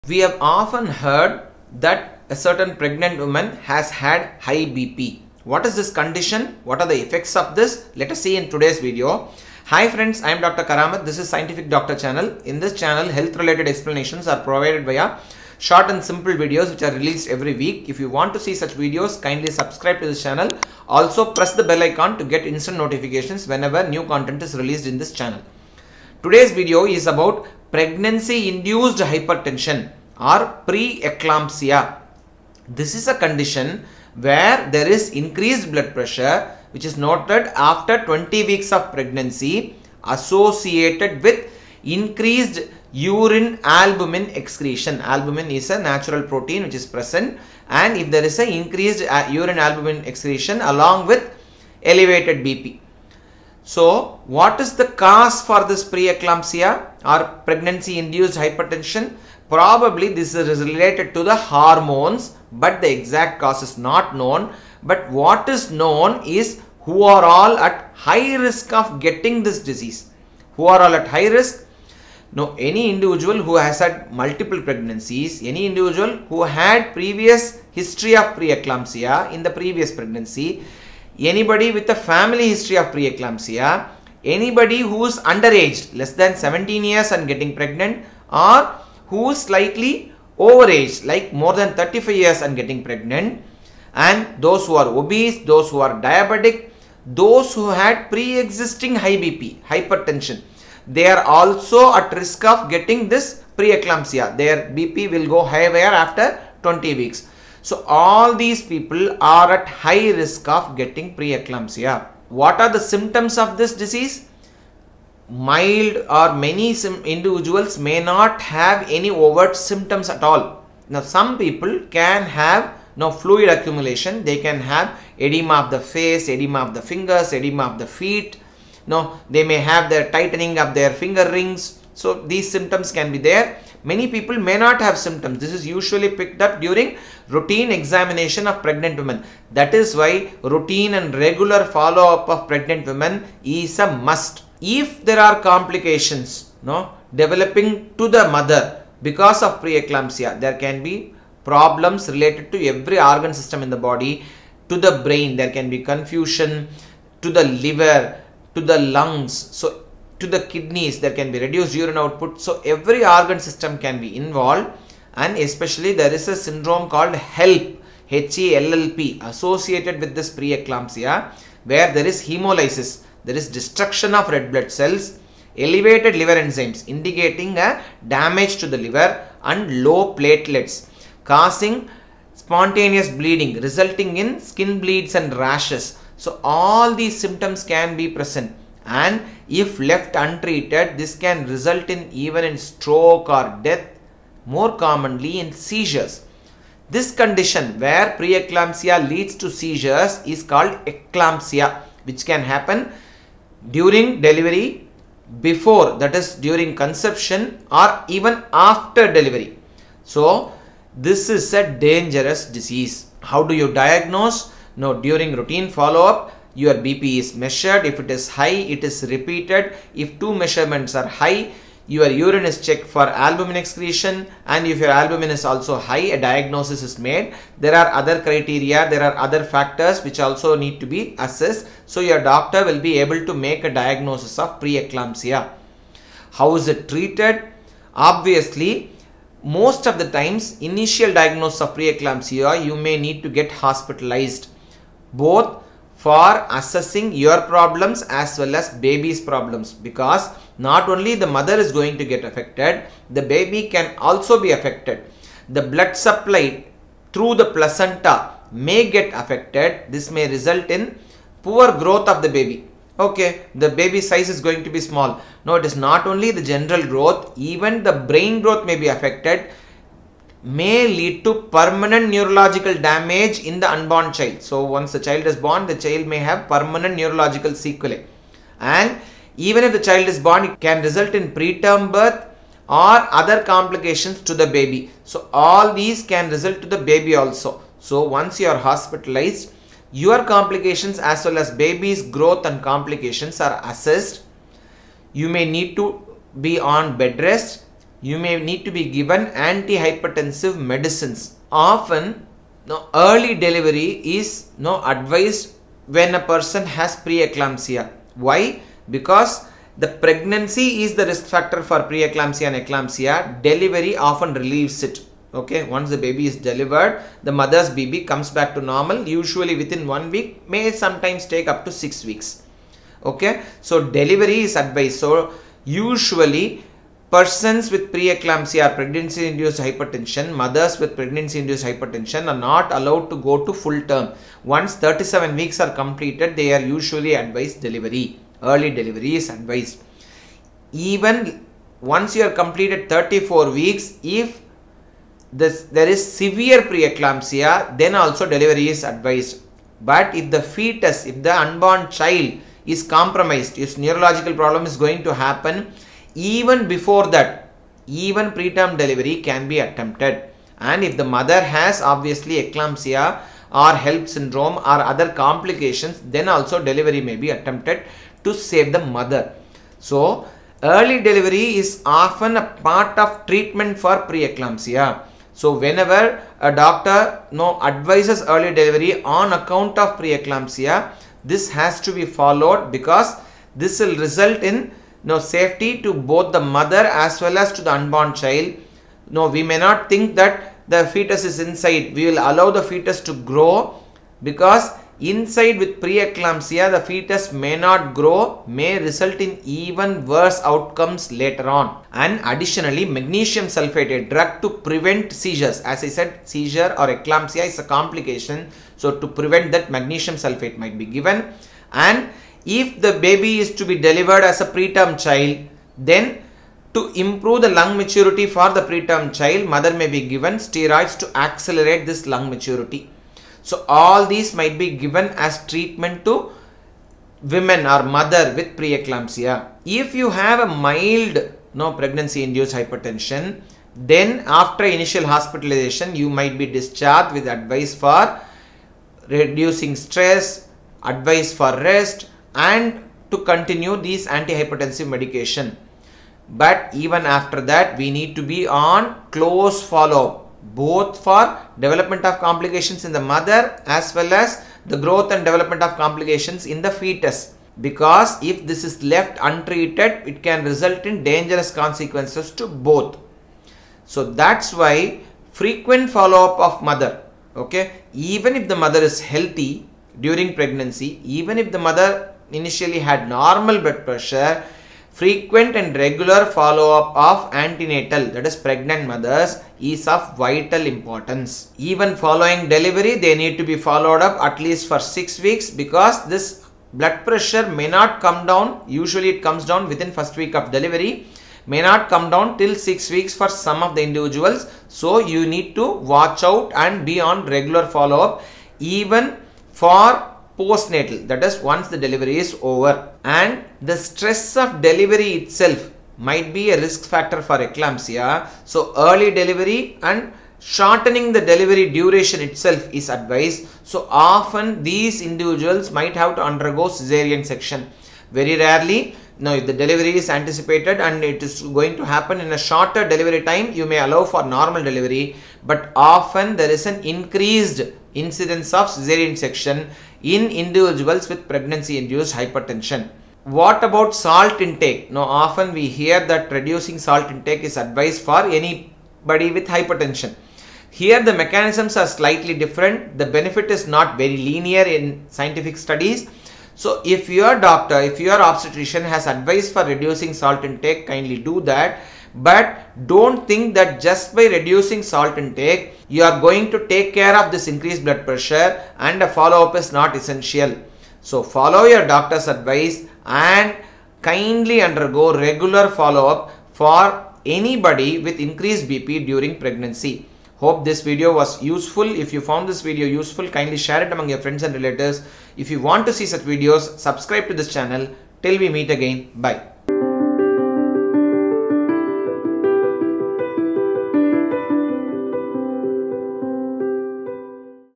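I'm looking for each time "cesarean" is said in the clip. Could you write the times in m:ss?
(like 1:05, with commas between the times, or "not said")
8:36, 8:48.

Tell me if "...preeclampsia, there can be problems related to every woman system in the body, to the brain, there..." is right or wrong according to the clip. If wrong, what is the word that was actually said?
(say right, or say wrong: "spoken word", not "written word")
wrong: "organ", not "woman".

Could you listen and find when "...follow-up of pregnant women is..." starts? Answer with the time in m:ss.
2:21.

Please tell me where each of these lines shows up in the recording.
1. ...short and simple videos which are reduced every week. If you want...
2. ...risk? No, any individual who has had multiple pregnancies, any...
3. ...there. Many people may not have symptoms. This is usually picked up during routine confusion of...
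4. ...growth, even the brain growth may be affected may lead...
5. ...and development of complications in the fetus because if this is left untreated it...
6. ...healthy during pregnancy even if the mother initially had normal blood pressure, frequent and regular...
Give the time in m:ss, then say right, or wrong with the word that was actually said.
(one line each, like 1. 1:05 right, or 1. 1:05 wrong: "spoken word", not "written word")
1. 0:15 wrong: "released", not "reduced"
2. 1:11 right
3. 2:13 wrong: "examination", not "confusion"
4. 4:26 right
5. 7:35 right
6. 7:49 right.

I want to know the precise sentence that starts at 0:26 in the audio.
Today's video is about pregnancy induced hypertension or preeclampsia.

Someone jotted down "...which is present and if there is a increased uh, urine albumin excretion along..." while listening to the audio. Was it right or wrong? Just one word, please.
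right.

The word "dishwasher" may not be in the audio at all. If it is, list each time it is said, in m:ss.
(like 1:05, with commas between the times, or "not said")
not said.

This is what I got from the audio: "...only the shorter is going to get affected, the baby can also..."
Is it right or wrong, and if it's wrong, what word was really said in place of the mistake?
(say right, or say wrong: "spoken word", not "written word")
wrong: "mother", not "shorter".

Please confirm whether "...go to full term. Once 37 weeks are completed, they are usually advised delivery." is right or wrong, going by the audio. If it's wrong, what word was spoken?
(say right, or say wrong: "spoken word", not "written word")
right.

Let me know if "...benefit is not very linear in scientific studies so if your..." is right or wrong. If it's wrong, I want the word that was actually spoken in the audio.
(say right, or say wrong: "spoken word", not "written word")
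right.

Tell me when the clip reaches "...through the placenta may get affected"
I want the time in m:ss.
4:17.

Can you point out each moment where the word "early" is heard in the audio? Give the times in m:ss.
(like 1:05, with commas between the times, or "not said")
5:02, 5:38, 6:10, 6:18, 8:28.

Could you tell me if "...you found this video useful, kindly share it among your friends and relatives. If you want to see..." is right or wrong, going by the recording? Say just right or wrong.
right.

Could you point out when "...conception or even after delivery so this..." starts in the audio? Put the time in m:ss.
3:26.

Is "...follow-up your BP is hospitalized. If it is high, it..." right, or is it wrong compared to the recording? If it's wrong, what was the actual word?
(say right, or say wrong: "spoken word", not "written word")
wrong: "measured", not "hospitalized".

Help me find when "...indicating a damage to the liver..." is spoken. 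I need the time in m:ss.
2:56.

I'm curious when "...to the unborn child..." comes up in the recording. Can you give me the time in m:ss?
6:27.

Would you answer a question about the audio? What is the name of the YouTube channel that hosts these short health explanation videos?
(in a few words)
Scientific Doctor.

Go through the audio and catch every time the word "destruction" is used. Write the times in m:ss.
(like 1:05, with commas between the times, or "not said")
2:53.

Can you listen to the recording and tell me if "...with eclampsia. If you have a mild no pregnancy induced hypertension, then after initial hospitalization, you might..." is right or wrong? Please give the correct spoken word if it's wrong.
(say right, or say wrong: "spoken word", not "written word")
wrong: "preeclampsia", not "eclampsia".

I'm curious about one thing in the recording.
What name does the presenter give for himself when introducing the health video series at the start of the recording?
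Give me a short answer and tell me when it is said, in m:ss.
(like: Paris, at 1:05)
Dr. Karamat, at 0:10.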